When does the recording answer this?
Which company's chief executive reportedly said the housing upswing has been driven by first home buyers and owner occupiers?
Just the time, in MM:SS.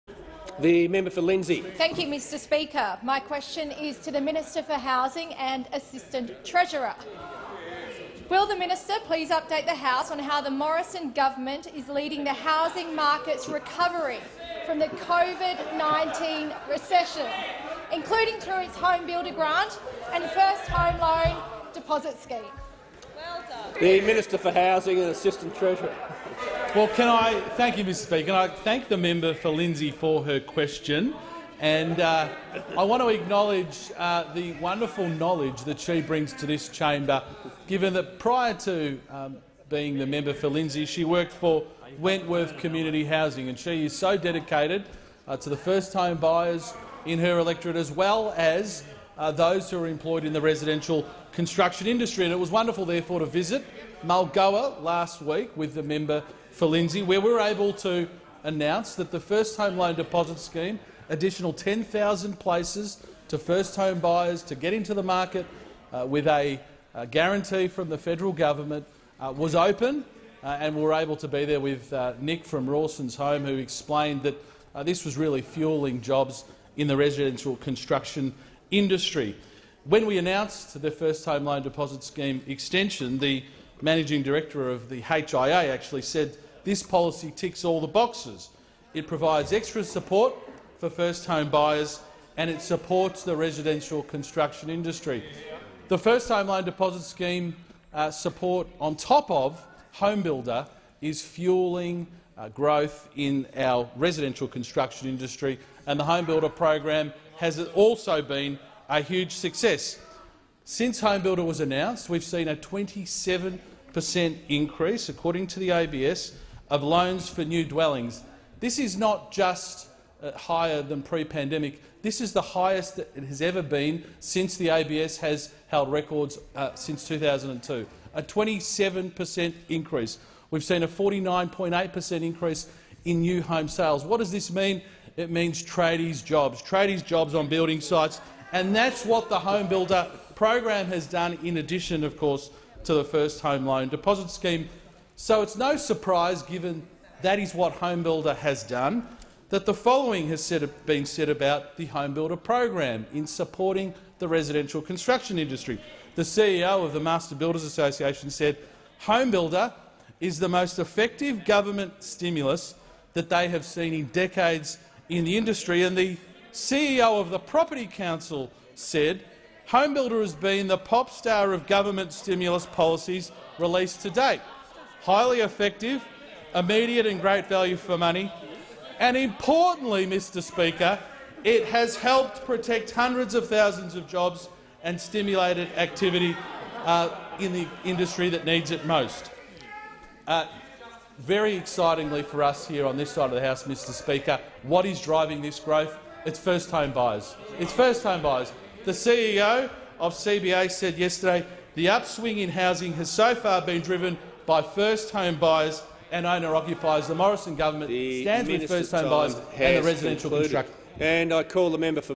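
03:20.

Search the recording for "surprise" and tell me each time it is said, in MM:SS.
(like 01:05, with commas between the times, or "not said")
02:25.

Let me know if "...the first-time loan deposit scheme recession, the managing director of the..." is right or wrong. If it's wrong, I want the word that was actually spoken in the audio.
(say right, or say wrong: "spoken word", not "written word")
wrong: "extension", not "recession".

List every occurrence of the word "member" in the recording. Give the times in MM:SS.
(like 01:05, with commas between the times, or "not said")
00:00, 00:28, 00:40, 00:55, 03:31.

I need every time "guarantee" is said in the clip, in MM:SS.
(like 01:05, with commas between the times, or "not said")
01:07.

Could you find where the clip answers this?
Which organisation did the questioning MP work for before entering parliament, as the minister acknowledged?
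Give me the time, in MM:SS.
00:41.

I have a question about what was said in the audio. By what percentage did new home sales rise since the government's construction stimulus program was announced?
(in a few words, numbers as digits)
49.8%.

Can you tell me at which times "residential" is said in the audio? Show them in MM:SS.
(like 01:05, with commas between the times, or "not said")
00:50, 01:16, 01:33, 01:43, 02:34, 03:29.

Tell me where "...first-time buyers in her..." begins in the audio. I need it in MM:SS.
00:45.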